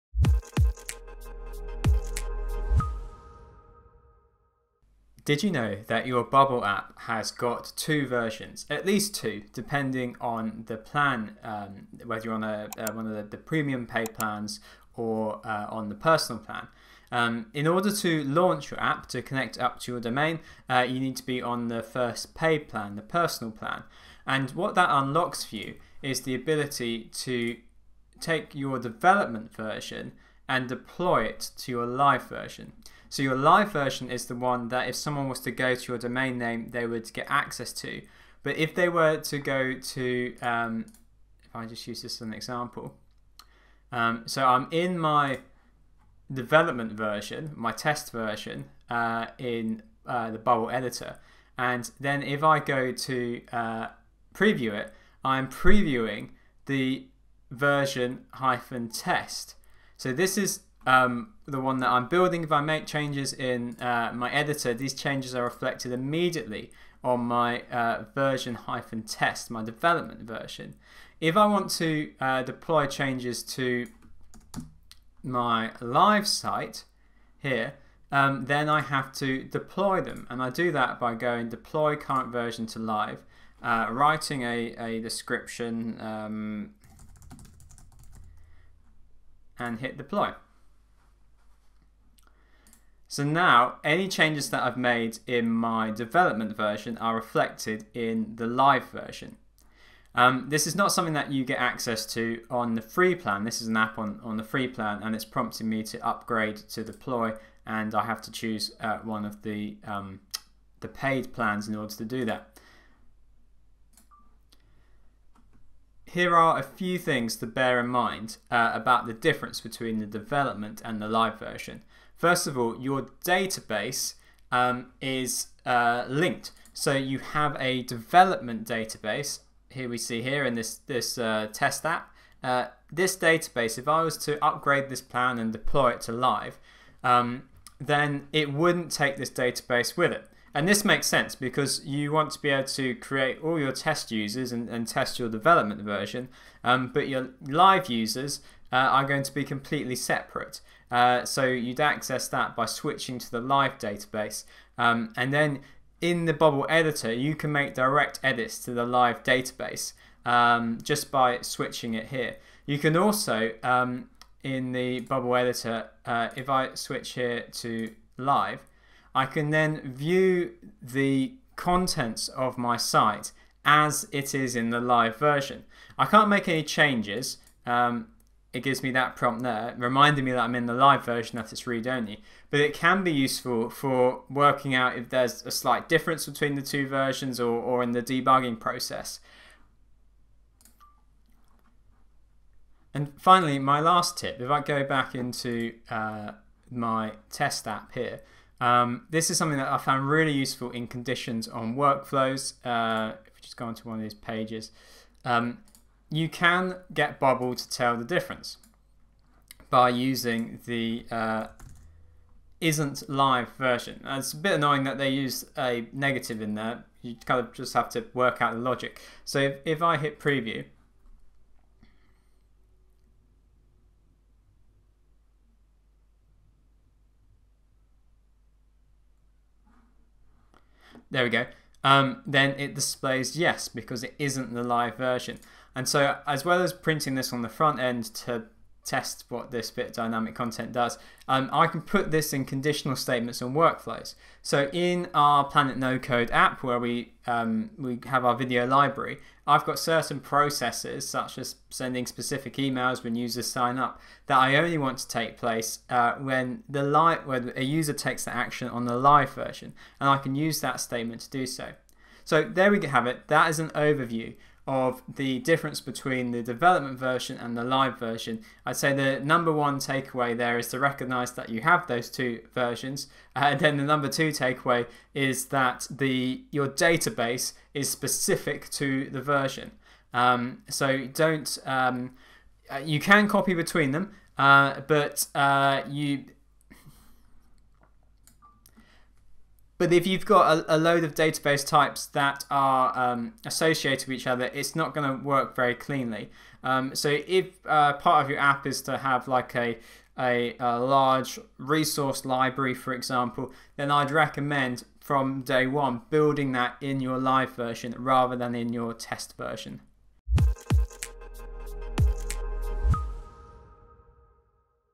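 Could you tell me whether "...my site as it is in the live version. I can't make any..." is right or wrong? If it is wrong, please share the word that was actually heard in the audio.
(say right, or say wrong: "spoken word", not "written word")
right.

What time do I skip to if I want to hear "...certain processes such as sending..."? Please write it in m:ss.
4:09.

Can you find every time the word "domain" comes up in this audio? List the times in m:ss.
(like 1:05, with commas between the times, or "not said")
0:20, 0:35.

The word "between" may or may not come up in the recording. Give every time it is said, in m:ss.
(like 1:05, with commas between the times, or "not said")
1:59, 3:06, 4:25, 4:43.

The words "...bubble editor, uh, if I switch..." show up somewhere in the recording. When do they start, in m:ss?
2:44.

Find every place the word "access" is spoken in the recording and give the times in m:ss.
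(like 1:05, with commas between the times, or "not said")
0:37, 1:41, 2:31.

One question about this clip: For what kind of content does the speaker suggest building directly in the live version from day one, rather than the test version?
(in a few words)
resource library.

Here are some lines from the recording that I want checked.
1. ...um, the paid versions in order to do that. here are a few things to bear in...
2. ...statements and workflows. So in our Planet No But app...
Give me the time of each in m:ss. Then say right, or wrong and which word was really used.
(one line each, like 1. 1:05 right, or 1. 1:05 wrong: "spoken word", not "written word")
1. 1:49 wrong: "plans", not "versions"
2. 4:02 wrong: "Code", not "But".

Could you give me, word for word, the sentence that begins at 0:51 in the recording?
And then if I go to uh, preview it, I'm previewing the version hyphen test.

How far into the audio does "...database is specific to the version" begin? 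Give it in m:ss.
4:36.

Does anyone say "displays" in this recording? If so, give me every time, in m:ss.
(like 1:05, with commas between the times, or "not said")
3:52.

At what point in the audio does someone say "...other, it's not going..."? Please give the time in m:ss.
4:54.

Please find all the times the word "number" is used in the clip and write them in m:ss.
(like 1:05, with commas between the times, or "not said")
4:29, 4:33.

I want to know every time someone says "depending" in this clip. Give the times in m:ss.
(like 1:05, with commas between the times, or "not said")
0:09.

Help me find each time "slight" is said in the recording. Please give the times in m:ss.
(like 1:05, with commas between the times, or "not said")
3:05.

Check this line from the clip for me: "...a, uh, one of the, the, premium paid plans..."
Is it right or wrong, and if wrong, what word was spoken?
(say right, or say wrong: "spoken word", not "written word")
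right.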